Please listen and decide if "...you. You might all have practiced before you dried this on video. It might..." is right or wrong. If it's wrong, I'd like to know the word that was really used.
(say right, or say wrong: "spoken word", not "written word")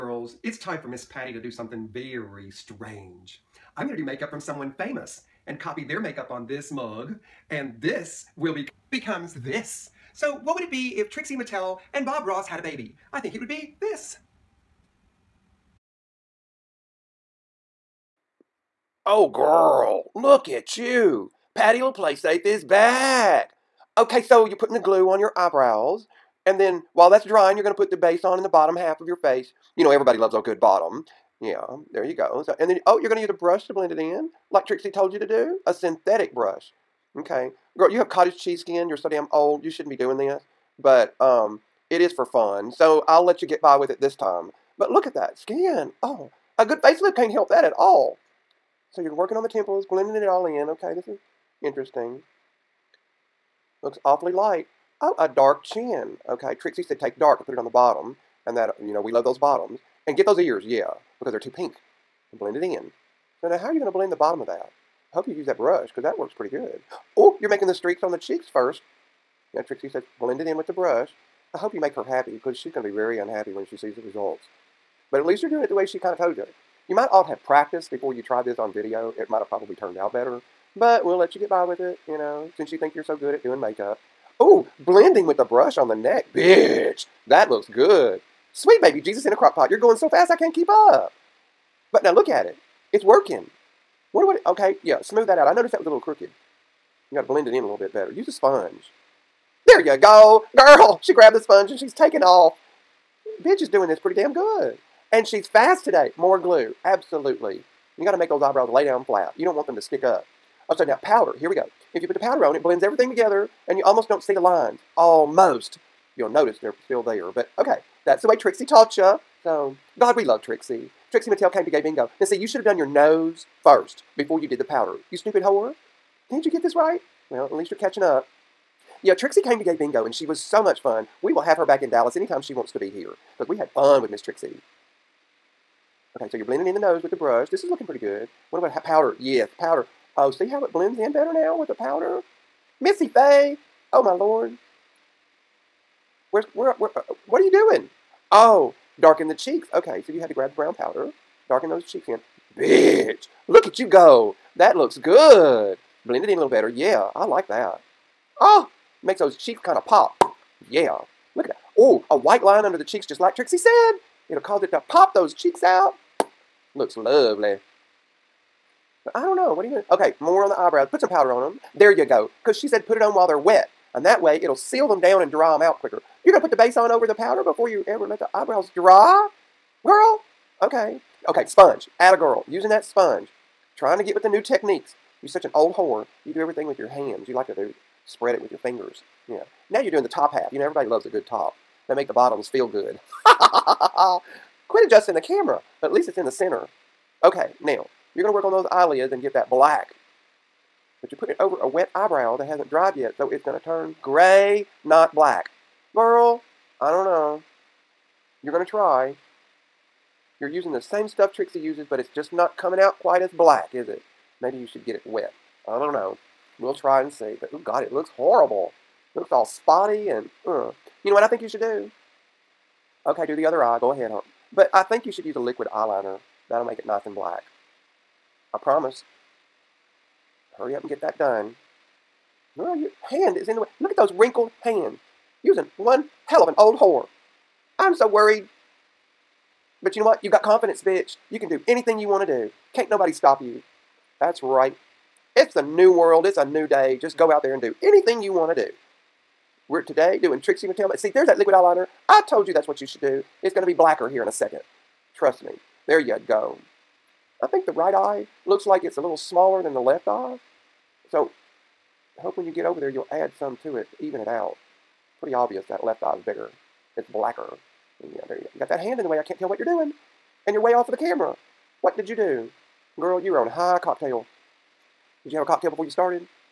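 wrong: "tried", not "dried".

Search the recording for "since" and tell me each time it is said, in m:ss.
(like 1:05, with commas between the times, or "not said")
1:22.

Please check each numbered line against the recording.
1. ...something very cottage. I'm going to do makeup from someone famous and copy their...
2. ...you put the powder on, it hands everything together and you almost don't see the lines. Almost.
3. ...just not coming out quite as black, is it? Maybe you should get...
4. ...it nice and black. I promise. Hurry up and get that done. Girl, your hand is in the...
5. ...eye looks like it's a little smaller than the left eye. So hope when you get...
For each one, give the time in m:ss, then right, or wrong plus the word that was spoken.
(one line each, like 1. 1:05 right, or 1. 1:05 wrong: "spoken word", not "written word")
1. 0:01 wrong: "strange", not "cottage"
2. 1:52 wrong: "blends", not "hands"
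3. 3:32 right
4. 3:46 right
5. 4:17 right.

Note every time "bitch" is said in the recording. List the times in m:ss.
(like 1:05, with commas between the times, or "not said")
1:26, 1:43, 2:32, 4:00.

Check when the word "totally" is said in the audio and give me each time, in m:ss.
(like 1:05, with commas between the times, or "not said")
not said.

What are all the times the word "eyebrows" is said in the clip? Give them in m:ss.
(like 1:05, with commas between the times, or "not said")
0:25, 1:48, 2:50, 2:58, 3:21.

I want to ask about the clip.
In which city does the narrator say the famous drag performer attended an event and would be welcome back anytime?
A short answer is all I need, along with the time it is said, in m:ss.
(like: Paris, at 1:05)
Dallas, at 2:11.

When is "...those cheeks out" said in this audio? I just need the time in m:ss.
2:45.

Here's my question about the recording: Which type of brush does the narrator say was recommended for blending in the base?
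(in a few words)
synthetic.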